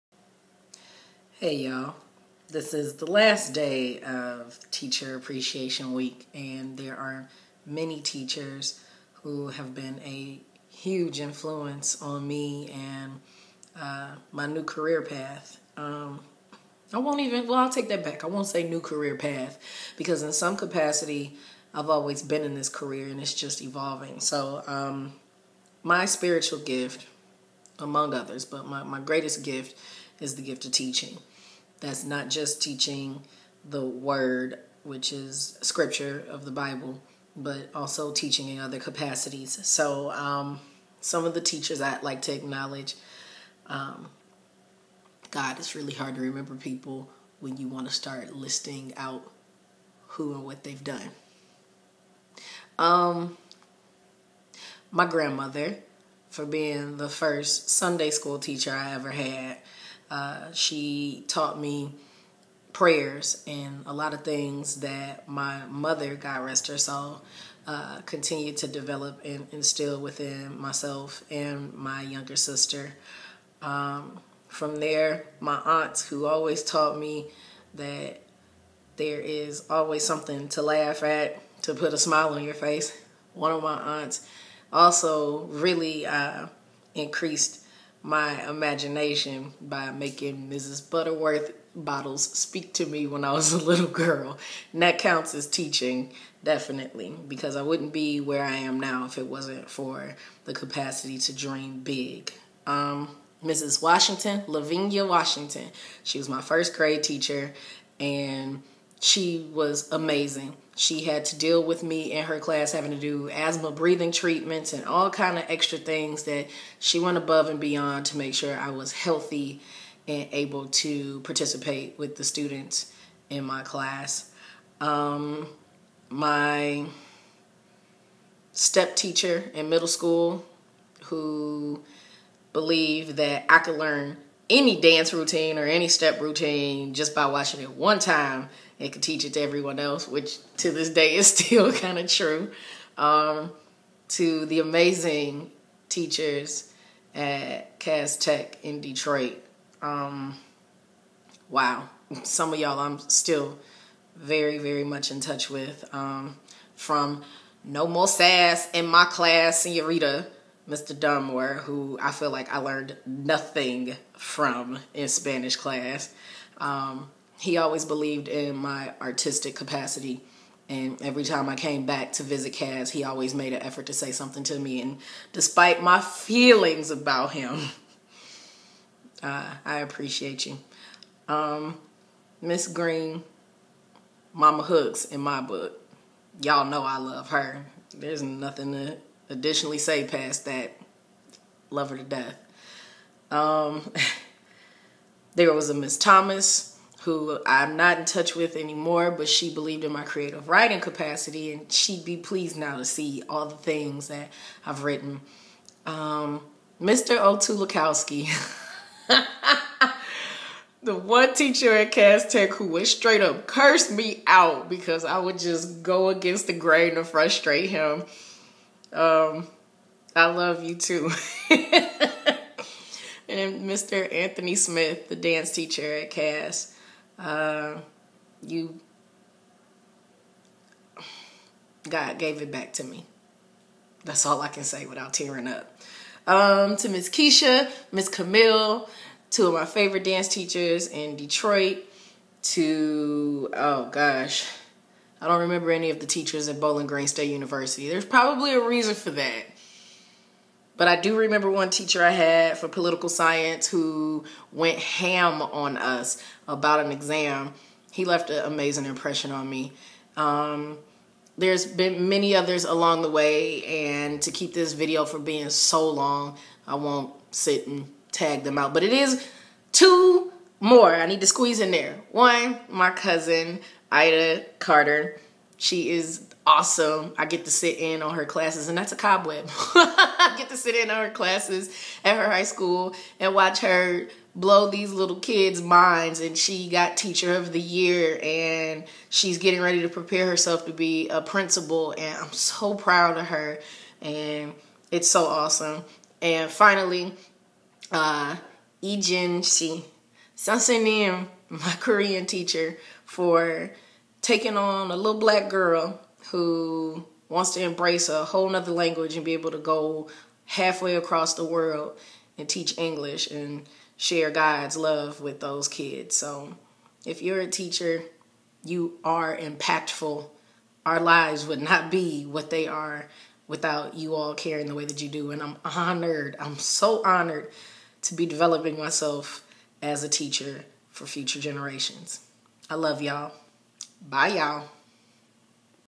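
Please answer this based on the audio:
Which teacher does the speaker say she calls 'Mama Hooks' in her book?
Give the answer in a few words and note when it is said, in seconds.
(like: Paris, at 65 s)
Miss Green, at 182 s.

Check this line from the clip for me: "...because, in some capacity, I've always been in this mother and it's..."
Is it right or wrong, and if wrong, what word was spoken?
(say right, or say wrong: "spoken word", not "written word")
wrong: "career", not "mother".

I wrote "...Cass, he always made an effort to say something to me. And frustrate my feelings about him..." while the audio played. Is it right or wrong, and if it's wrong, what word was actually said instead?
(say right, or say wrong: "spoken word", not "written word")
wrong: "despite", not "frustrate".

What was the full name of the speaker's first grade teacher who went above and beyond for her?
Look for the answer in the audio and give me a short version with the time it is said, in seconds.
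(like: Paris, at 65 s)
Lavinia Washington, at 104 s.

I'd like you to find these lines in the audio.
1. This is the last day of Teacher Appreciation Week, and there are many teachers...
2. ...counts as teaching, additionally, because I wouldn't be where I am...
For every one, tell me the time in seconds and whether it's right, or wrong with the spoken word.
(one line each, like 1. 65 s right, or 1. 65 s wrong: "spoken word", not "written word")
1. 2 s right
2. 94 s wrong: "definitely", not "additionally".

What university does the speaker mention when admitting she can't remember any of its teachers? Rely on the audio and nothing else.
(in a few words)
Bowling Green State University.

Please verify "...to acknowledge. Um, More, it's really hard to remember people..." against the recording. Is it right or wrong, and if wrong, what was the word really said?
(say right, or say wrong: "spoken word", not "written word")
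wrong: "God", not "More".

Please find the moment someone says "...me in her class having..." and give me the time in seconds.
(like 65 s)
111 s.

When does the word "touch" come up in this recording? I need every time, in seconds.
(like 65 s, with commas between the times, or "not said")
155 s, 198 s.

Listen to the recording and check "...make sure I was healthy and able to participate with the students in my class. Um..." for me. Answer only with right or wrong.
right.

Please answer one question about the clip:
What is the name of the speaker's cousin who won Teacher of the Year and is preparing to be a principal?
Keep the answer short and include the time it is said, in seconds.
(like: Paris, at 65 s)
Ida Carter, at 273 s.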